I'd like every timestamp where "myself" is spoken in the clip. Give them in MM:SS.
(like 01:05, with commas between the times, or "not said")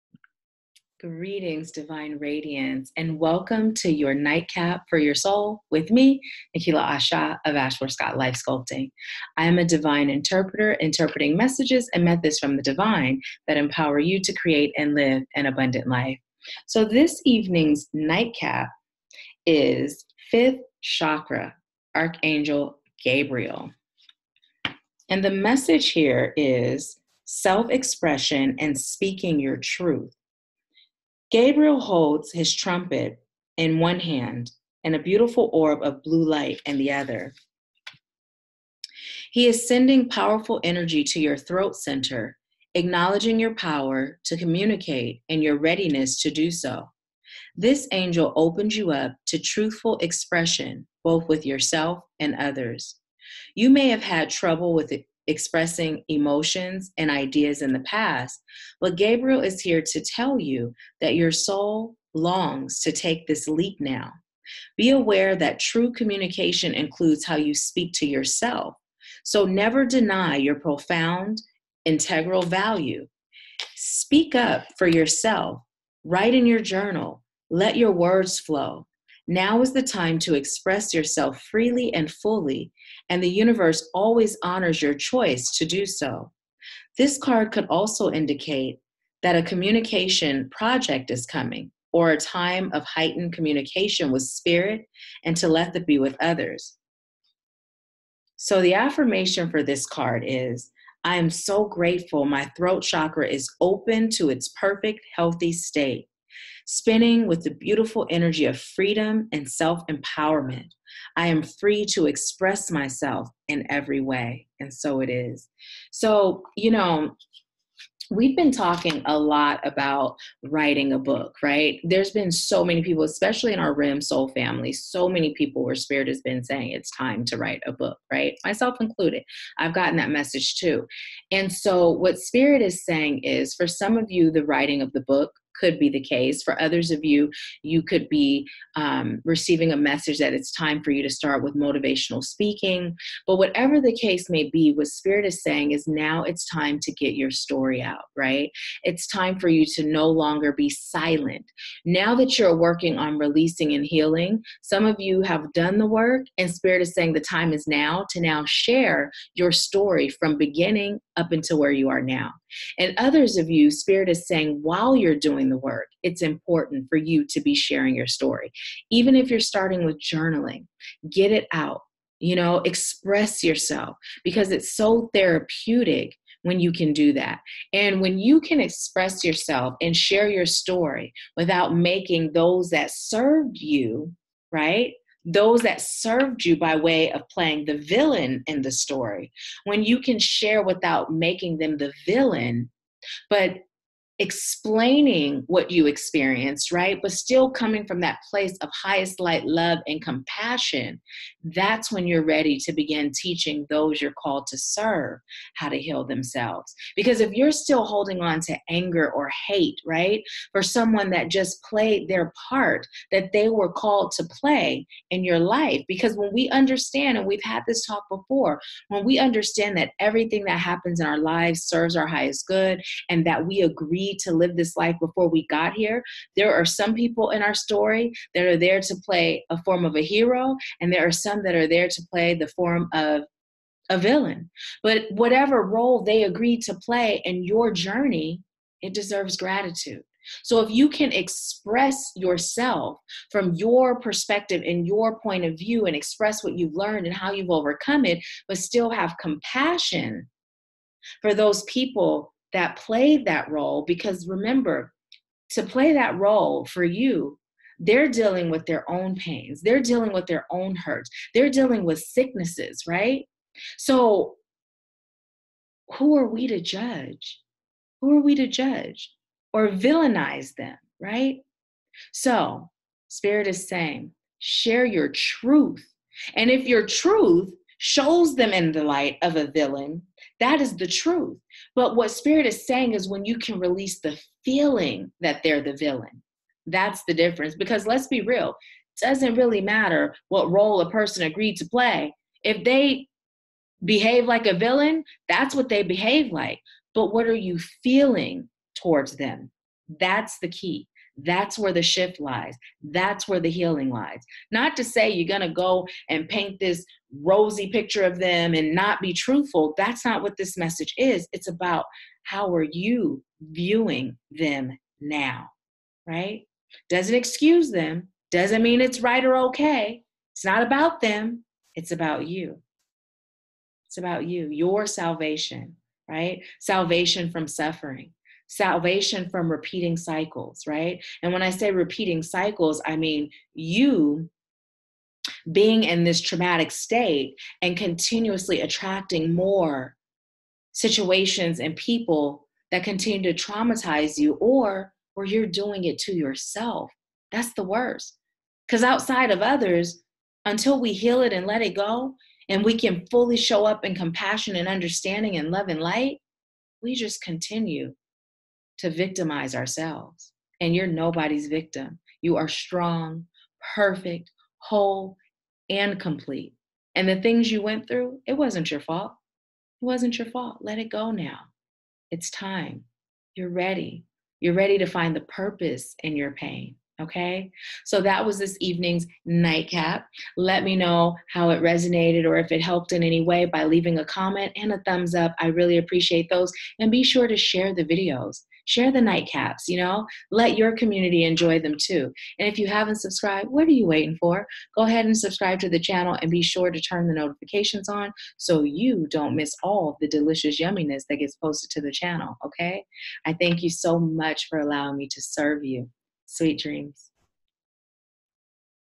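01:52, 02:08.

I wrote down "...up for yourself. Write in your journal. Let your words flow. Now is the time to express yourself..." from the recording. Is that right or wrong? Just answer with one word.
right.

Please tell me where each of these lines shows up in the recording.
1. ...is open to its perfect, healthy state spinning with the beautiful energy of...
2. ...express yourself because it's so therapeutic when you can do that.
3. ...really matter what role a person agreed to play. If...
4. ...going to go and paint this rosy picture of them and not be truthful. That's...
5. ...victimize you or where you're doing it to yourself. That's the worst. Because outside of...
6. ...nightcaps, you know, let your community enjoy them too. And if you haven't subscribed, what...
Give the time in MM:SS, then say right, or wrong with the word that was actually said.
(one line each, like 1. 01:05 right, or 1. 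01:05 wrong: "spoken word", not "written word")
1. 01:43 right
2. 02:52 right
3. 04:49 right
4. 05:05 right
5. 05:43 wrong: "traumatize", not "victimize"
6. 06:29 right.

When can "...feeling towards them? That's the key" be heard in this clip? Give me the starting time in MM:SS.
04:57.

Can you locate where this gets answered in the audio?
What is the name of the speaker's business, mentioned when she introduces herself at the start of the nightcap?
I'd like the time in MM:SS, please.
00:07.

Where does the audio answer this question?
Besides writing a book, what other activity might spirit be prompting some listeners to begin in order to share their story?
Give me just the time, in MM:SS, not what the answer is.
02:21.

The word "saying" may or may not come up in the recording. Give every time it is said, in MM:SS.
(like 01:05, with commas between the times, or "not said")
02:06, 02:12, 02:25, 02:36, 02:44, 04:33, 04:42.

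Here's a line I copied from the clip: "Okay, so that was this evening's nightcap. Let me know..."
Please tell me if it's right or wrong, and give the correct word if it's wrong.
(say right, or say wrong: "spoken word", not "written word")
right.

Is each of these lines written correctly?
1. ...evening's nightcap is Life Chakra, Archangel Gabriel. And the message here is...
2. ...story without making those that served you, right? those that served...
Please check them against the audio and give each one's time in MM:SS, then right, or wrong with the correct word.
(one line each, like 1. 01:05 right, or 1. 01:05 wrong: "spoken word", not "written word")
1. 00:17 wrong: "Fifth", not "Life"
2. 03:00 right.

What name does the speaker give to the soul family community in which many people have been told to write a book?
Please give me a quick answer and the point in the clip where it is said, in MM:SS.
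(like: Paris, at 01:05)
RIM, at 02:03.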